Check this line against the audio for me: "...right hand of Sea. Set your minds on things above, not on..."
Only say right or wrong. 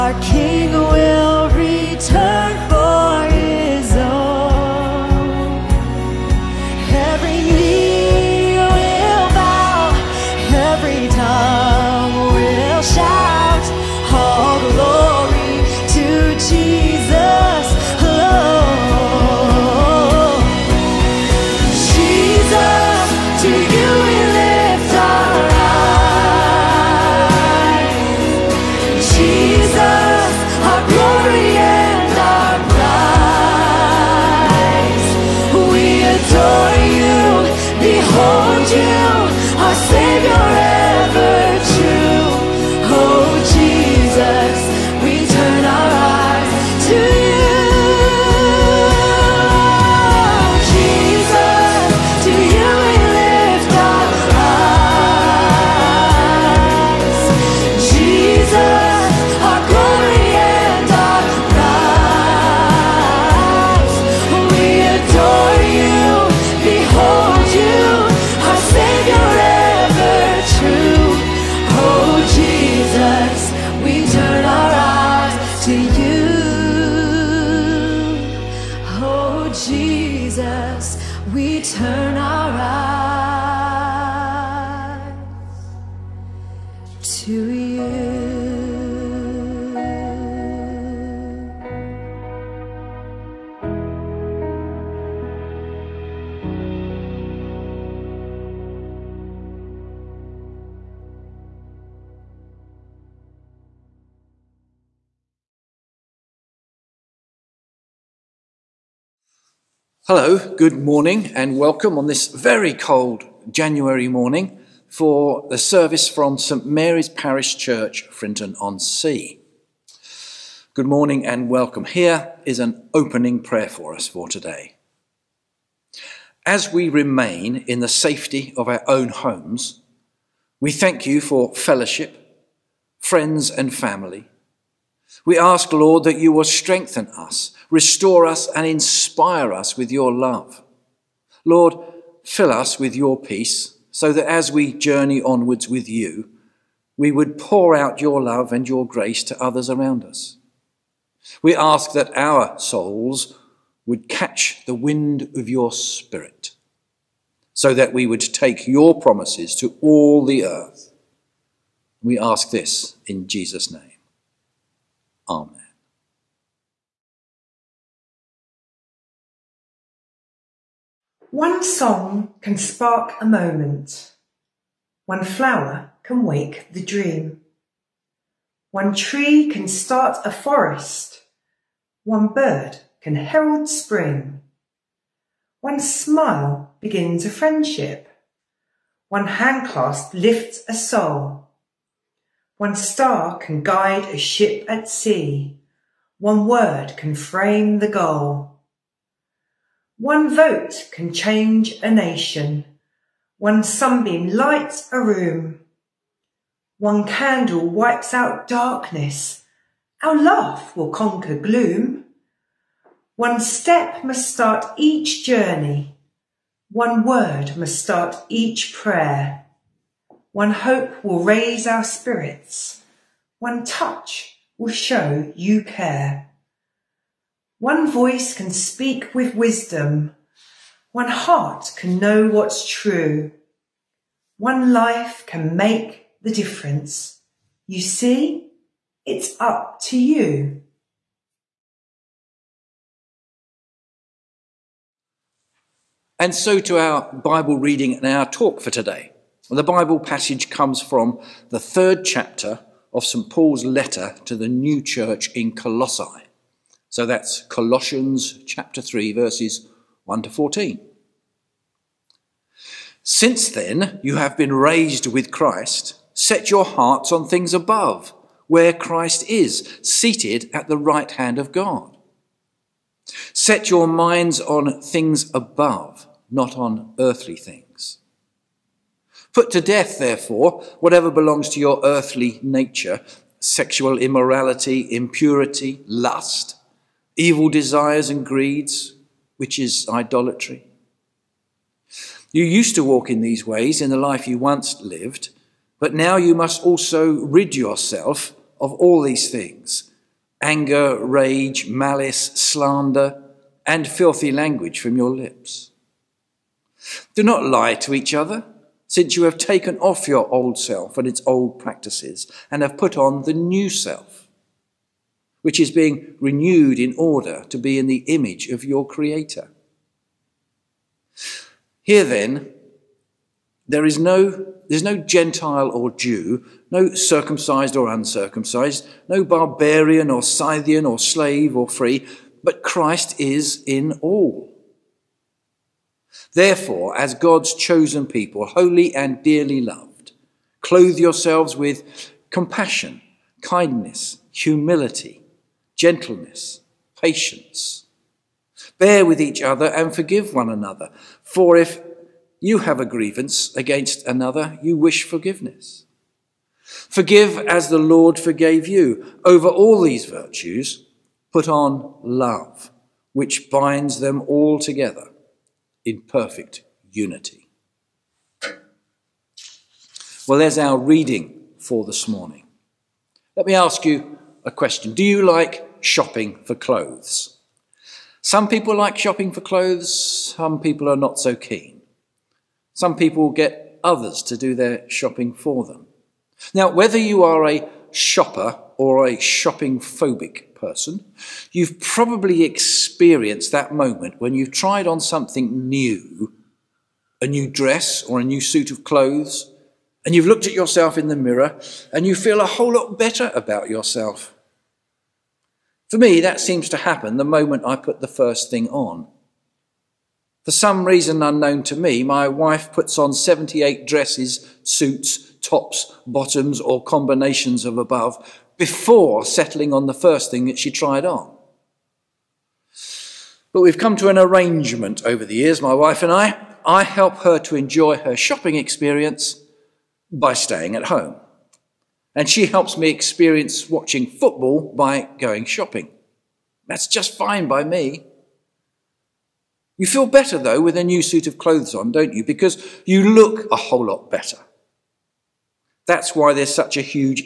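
wrong.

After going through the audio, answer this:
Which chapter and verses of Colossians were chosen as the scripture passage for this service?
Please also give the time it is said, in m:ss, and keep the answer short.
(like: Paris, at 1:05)
Chapter 3, verses 1 to 14, at 4:18.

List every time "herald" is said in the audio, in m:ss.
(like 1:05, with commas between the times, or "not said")
3:03.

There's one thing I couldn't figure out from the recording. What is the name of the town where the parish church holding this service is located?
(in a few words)
Frinton on Sea.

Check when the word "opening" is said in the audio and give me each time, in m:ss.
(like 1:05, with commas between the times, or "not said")
2:02.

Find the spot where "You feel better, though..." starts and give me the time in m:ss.
7:19.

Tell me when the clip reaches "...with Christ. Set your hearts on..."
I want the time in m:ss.
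4:25.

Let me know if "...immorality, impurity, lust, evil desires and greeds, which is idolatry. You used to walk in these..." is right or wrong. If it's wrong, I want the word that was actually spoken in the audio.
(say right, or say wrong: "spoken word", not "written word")
right.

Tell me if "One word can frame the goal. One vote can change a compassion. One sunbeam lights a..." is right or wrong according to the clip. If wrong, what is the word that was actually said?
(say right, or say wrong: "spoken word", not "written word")
wrong: "nation", not "compassion".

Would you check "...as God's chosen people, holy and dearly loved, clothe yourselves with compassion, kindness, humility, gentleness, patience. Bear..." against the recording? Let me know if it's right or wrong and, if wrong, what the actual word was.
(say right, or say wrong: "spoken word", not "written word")
right.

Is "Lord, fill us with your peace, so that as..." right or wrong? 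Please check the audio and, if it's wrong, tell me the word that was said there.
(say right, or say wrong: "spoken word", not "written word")
right.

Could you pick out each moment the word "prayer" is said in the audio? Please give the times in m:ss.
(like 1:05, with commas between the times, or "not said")
2:03, 3:38.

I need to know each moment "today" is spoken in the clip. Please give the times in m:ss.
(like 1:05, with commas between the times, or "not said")
2:04, 4:08.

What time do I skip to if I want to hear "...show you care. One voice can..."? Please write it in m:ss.
3:44.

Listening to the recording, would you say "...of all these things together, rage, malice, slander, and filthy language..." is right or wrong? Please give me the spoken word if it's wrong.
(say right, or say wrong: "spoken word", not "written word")
wrong: "anger", not "together".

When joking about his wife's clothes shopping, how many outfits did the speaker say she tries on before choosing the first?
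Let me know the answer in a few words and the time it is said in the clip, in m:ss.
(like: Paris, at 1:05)
78, at 6:53.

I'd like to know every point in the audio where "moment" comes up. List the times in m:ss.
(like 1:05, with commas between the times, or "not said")
2:53, 6:33, 6:47.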